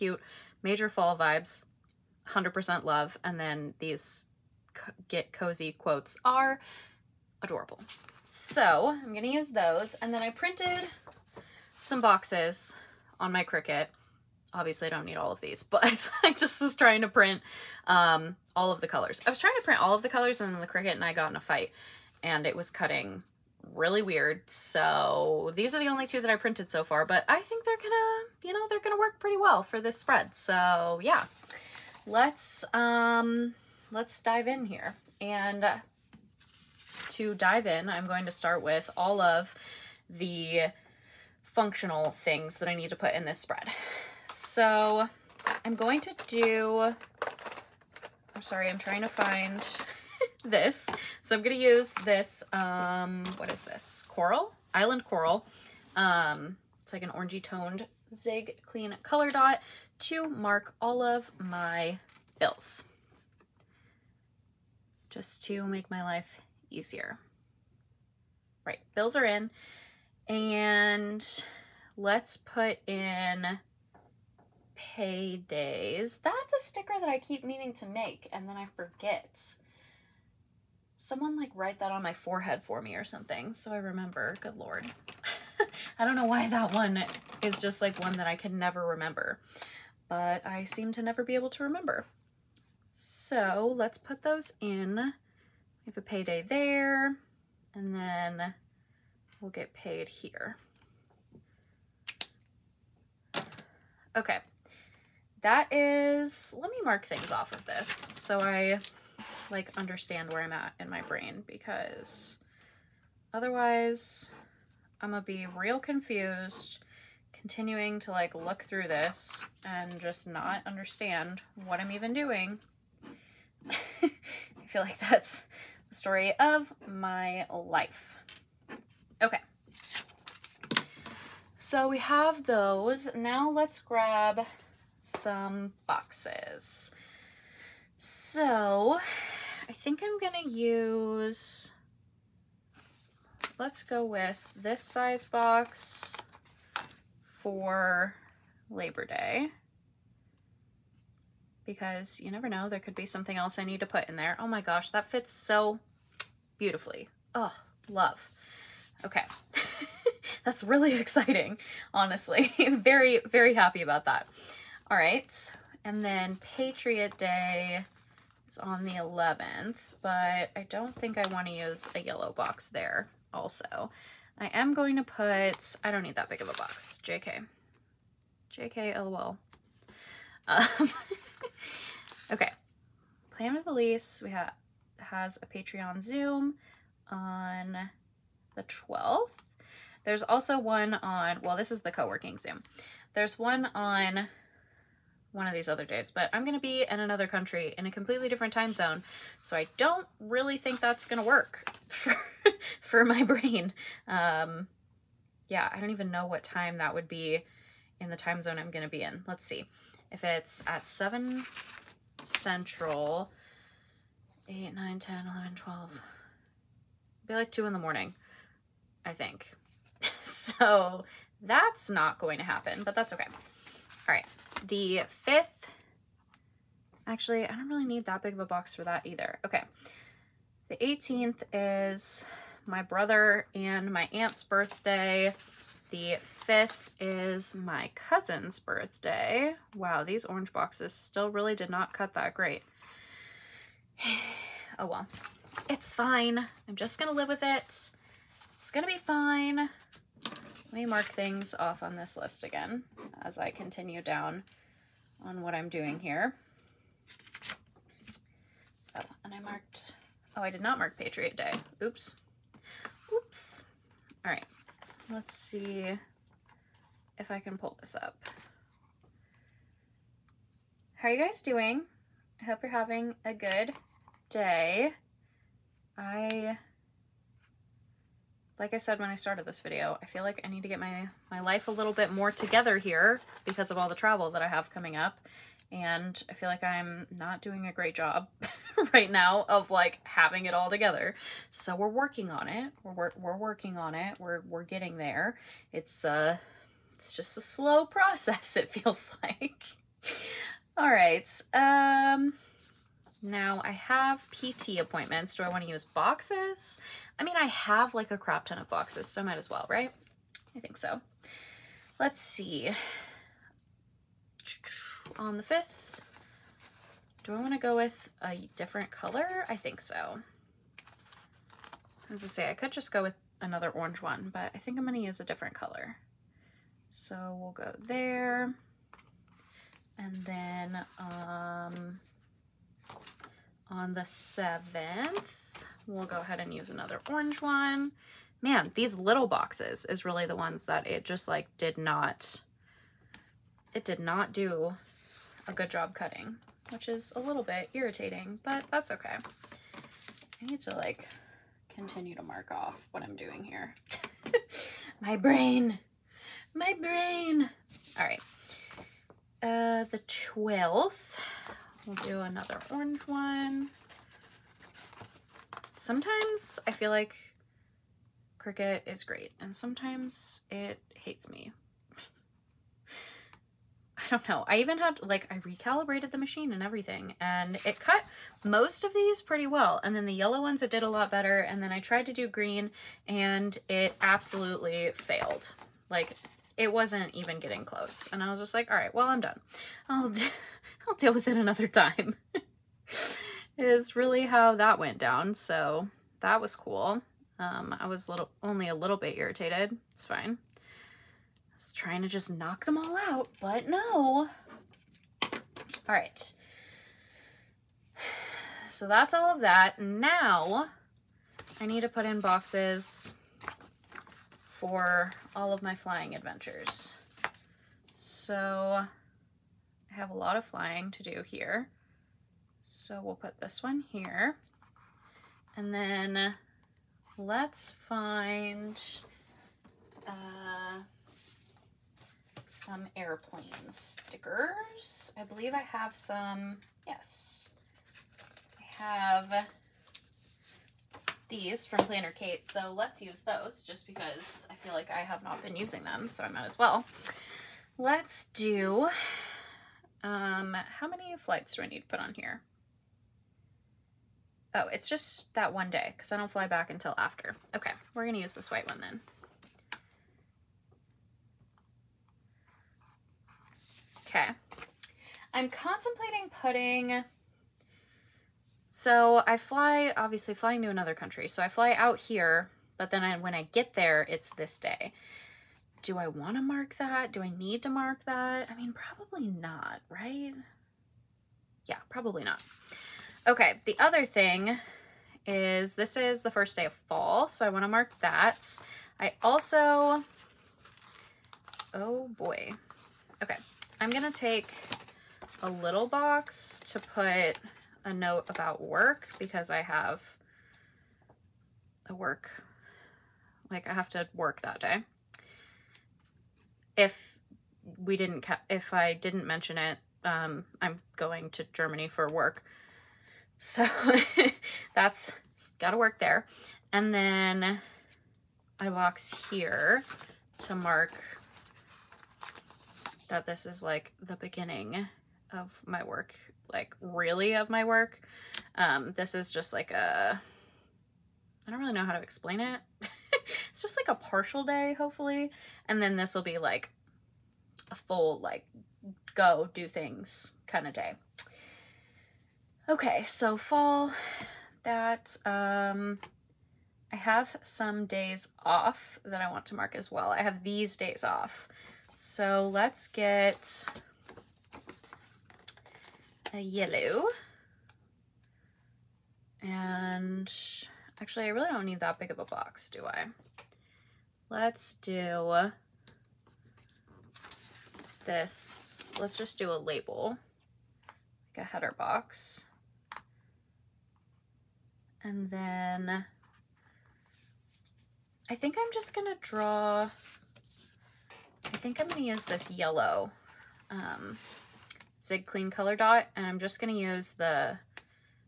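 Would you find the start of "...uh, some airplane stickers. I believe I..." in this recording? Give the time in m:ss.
7:10.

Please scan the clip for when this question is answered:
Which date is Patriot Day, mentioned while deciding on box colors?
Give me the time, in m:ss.
2:48.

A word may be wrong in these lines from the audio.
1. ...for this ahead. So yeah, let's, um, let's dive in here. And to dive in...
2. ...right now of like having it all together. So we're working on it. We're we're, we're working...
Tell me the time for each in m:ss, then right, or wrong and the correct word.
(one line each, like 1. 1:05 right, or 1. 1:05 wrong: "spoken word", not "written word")
1. 0:29 wrong: "spread", not "ahead"
2. 4:48 right.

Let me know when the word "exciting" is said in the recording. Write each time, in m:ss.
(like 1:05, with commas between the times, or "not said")
2:41.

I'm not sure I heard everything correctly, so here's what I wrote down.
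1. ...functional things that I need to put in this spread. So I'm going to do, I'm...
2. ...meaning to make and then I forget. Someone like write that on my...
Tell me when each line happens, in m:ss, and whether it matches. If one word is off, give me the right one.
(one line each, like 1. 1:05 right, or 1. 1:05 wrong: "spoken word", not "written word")
1. 0:41 right
2. 1:17 right.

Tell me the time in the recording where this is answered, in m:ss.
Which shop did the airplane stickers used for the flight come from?
7:21.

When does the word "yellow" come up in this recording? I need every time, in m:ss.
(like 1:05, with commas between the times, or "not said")
2:51, 6:20, 9:16, 9:42.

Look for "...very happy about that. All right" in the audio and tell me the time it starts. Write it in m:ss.
2:43.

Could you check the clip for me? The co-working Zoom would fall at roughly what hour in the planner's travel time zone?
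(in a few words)
2 in the morning.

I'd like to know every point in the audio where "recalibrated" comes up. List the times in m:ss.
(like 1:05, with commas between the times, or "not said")
6:15.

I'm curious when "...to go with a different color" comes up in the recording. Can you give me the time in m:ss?
5:17.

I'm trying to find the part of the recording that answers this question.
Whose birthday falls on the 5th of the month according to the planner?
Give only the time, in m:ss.
3:57.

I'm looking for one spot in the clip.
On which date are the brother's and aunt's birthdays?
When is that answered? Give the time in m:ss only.
3:50.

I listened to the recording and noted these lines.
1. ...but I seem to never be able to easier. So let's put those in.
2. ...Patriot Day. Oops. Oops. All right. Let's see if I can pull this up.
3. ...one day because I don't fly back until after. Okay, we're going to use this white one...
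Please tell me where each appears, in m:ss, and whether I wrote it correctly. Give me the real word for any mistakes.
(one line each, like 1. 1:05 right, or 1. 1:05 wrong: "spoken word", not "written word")
1. 1:30 wrong: "remember", not "easier"
2. 4:20 right
3. 7:35 right.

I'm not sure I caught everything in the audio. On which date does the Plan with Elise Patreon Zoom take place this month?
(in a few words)
12th.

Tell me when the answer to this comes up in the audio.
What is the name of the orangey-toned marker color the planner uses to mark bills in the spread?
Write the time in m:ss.
0:54.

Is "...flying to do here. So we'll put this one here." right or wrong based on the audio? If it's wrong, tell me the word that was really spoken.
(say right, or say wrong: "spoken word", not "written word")
right.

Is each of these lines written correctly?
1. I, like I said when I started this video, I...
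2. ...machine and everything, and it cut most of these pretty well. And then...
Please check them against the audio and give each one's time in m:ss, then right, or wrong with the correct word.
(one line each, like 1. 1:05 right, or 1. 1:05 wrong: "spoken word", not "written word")
1. 4:35 right
2. 6:16 right.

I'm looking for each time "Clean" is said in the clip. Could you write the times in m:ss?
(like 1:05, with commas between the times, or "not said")
0:58, 9:45.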